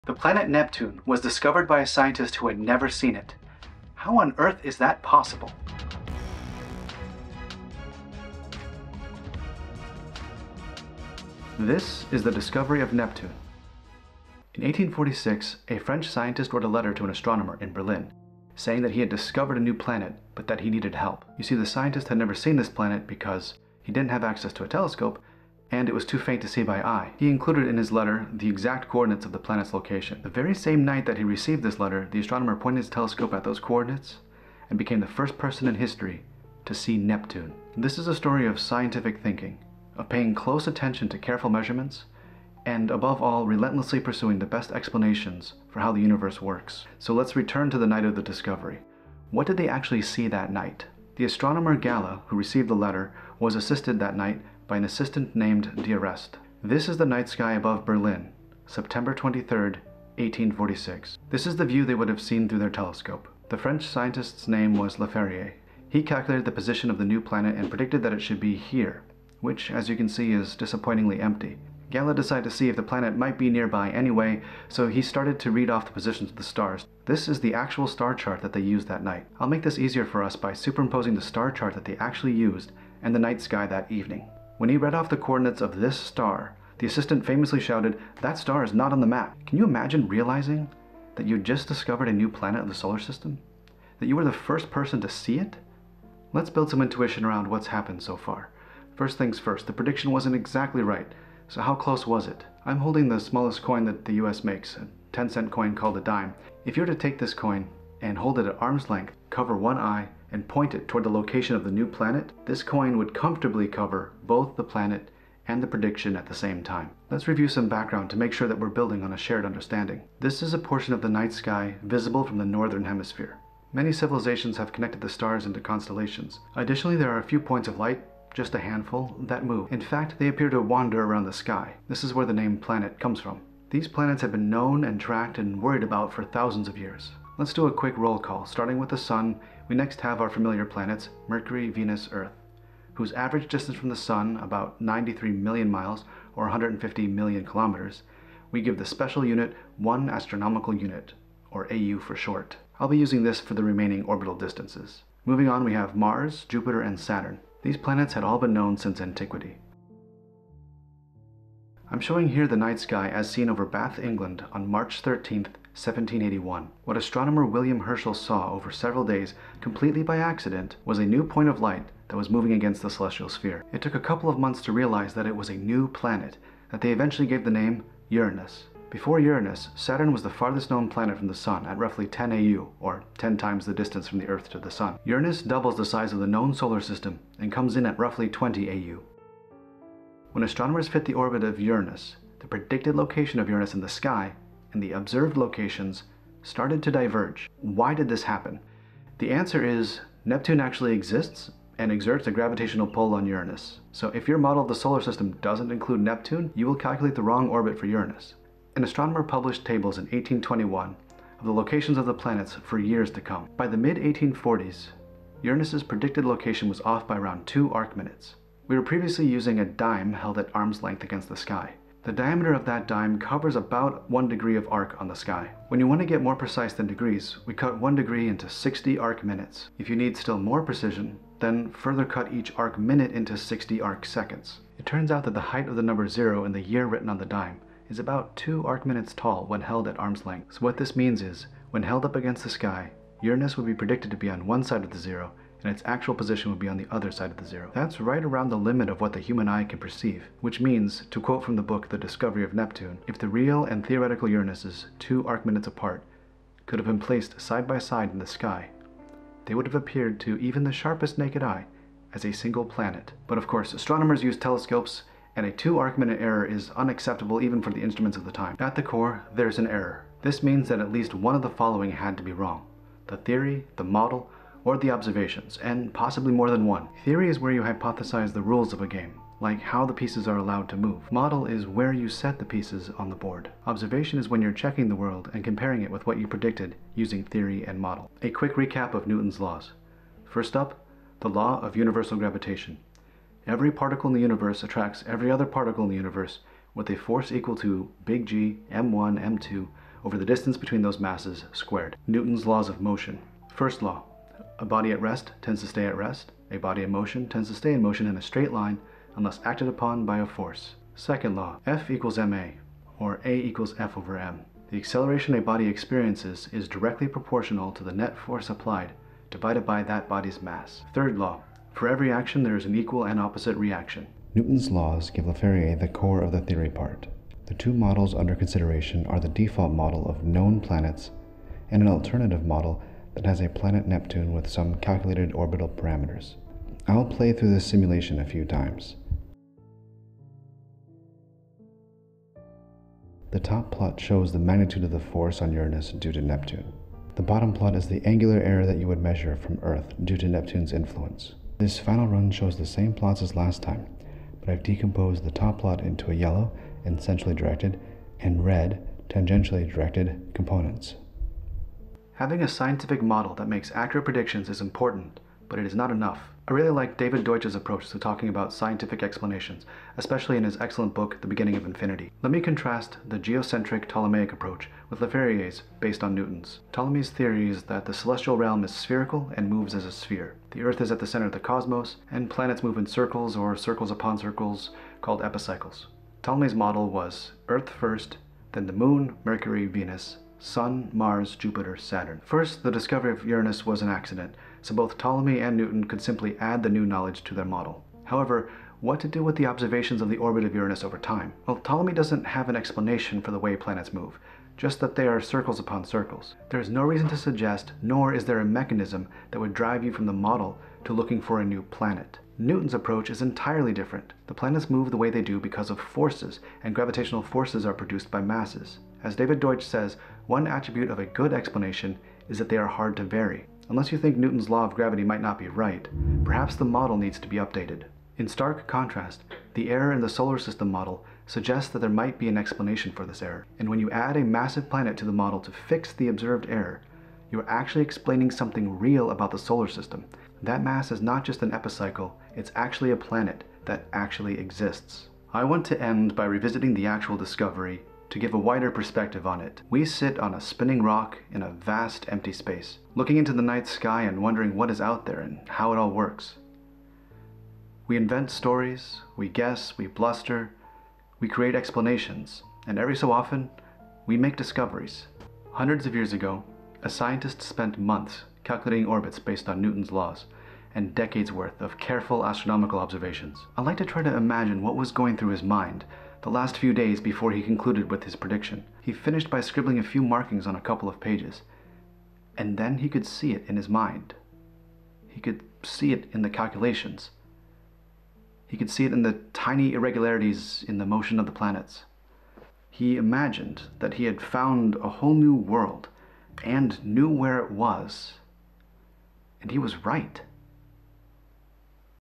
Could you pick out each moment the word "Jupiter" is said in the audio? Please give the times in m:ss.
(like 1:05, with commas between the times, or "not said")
2:36, 6:31.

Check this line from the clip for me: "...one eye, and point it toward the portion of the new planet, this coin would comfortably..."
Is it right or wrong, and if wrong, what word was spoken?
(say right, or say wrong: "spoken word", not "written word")
wrong: "location", not "portion".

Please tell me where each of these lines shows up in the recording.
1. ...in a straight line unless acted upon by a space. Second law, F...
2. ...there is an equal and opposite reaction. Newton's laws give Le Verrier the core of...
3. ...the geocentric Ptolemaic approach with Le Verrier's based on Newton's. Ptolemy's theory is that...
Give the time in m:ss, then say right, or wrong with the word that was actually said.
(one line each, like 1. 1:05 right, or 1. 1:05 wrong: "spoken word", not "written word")
1. 5:08 wrong: "force", not "space"
2. 5:22 right
3. 6:13 right.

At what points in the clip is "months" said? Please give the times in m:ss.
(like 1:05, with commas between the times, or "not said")
2:54, 7:47.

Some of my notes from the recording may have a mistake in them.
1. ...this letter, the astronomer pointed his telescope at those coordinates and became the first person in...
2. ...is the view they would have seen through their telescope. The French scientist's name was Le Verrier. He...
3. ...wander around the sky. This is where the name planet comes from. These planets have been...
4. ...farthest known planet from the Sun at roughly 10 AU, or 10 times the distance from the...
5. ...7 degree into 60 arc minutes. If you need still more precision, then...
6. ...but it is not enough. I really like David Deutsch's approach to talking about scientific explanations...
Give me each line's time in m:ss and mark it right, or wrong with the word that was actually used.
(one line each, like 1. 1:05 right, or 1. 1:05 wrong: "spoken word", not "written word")
1. 0:31 right
2. 1:01 right
3. 2:10 right
4. 3:00 right
5. 3:47 wrong: "1", not "7"
6. 6:05 right.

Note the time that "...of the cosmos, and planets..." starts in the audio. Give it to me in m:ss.
6:21.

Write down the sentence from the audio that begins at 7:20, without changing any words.
That mass is not just an epicycle, it's actually a planet that actually exists.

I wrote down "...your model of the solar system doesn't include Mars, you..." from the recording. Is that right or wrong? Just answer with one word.
wrong.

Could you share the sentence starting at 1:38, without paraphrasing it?
First things first, the prediction wasn't exactly right, so how close was it?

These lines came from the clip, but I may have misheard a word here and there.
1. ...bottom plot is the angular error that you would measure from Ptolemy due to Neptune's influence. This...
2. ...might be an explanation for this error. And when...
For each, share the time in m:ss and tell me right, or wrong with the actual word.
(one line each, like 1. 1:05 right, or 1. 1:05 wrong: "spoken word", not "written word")
1. 5:47 wrong: "Earth", not "Ptolemy"
2. 7:11 right.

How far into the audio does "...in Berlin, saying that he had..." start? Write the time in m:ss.
0:17.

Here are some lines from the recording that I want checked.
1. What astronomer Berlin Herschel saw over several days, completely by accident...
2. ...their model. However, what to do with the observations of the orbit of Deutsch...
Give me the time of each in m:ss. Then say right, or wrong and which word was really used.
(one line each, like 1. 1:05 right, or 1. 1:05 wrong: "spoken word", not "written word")
1. 2:46 wrong: "William", not "Berlin"
2. 6:37 wrong: "Uranus", not "Deutsch".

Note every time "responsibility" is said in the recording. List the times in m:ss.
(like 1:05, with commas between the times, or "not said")
not said.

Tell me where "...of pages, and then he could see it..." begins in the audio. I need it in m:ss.
8:00.